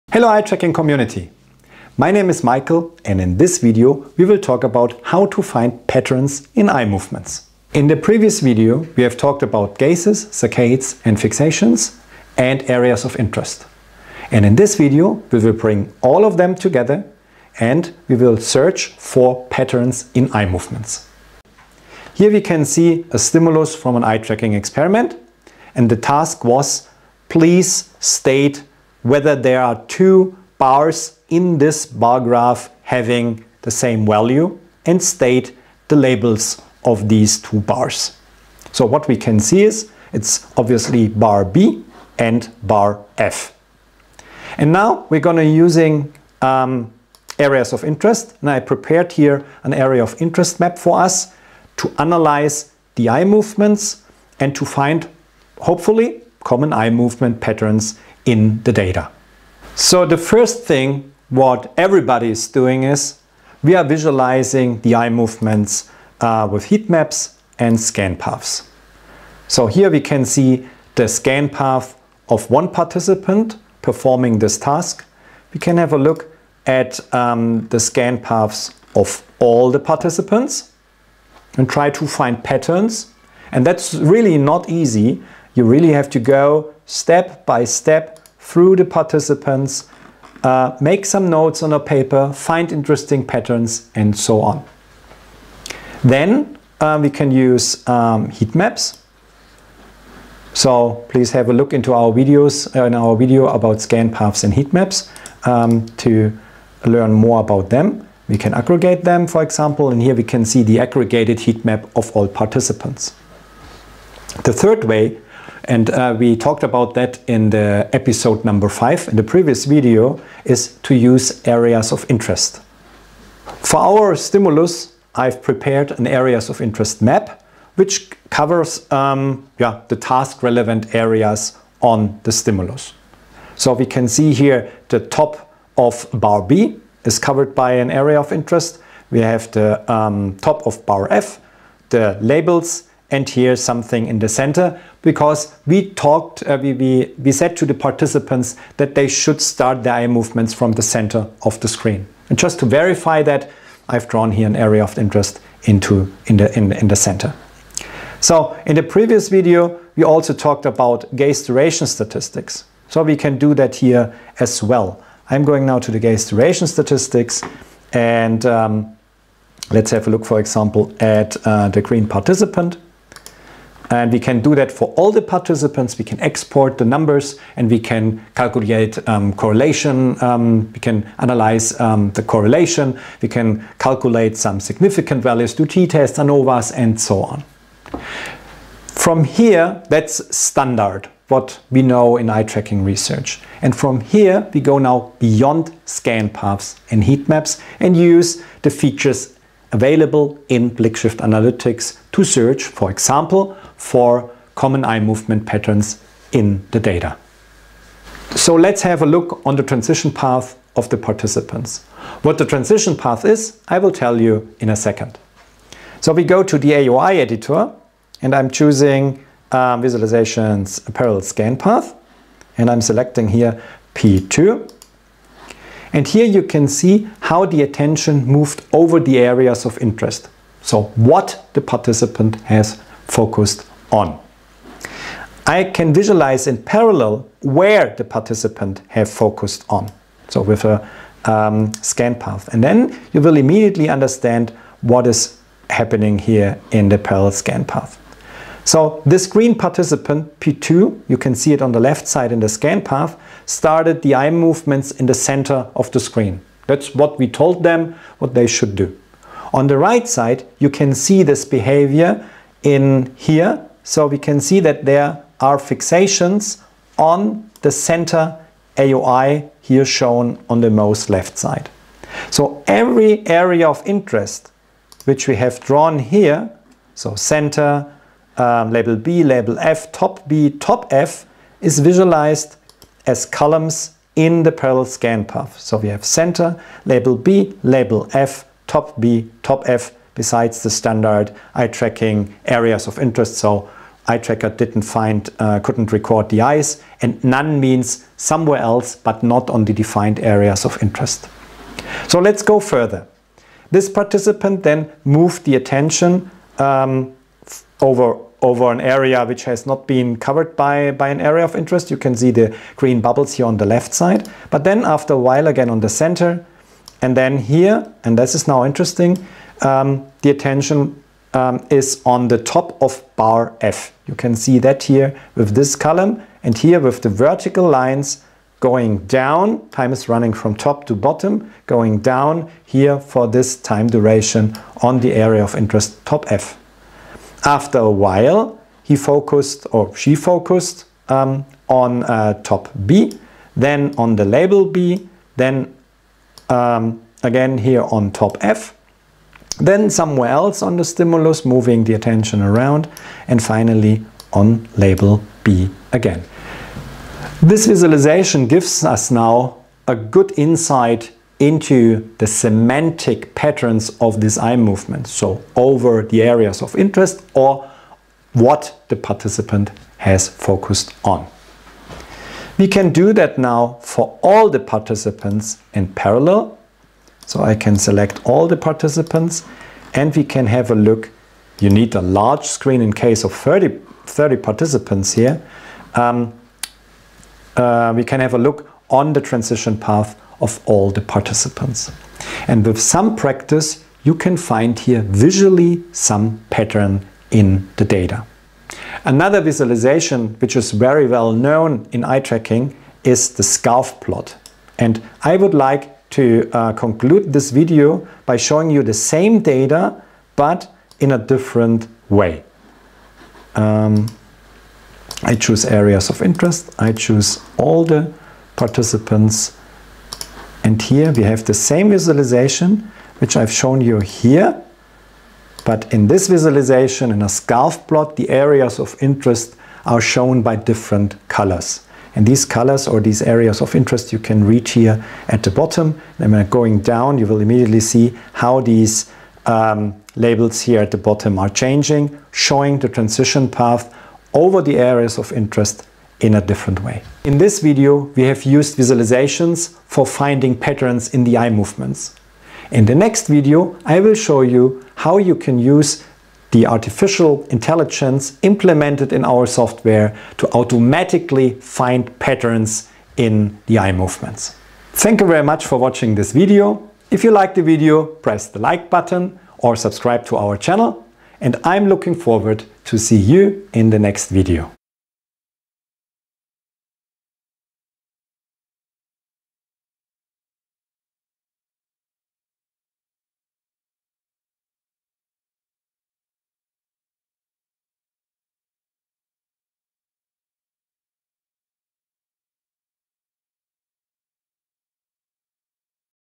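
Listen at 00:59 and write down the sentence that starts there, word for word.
So the first thing what everybody is doing is we are visualizing the eye movements uh, with heat maps and scan paths.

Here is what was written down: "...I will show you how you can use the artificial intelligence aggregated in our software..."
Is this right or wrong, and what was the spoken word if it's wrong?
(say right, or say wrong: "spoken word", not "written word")
wrong: "implemented", not "aggregated".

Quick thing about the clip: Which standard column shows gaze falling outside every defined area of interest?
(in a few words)
None.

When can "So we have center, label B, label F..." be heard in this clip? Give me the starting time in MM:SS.
04:45.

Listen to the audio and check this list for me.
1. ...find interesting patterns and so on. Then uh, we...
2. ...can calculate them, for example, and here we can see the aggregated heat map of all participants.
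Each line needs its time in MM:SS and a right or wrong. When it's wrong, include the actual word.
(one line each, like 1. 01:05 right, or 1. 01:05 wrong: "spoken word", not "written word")
1. 01:32 right
2. 01:48 wrong: "aggregate", not "calculate".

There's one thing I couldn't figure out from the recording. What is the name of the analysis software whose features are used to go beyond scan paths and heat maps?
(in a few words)
BlickShift Analytics.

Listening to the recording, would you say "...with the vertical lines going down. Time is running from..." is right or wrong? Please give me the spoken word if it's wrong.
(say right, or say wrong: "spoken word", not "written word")
right.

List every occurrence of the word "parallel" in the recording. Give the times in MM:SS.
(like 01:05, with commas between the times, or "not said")
03:40, 03:56, 04:06, 04:44, 06:15.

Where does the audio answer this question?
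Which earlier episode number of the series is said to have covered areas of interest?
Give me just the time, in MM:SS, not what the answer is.
01:57.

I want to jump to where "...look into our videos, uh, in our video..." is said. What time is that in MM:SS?
01:41.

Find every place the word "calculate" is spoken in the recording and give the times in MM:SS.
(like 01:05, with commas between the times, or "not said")
02:58, 03:03.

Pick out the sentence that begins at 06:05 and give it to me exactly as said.
So over the areas of interest or what the participant has focused on.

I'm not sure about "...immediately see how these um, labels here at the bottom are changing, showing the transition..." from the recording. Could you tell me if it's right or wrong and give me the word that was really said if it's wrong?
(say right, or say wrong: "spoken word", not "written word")
right.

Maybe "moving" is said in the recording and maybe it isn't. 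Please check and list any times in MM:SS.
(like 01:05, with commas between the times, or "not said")
05:51.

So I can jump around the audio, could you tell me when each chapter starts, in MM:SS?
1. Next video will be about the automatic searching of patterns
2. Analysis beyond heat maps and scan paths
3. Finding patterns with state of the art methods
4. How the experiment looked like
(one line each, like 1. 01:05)
1. 07:30
2. 03:06
3. 01:06
4. 00:22.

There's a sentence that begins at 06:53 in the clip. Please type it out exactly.
Um, I choose areas of interest.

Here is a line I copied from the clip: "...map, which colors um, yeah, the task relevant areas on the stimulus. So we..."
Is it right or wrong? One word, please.
wrong.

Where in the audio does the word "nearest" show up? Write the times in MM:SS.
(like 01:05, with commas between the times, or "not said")
not said.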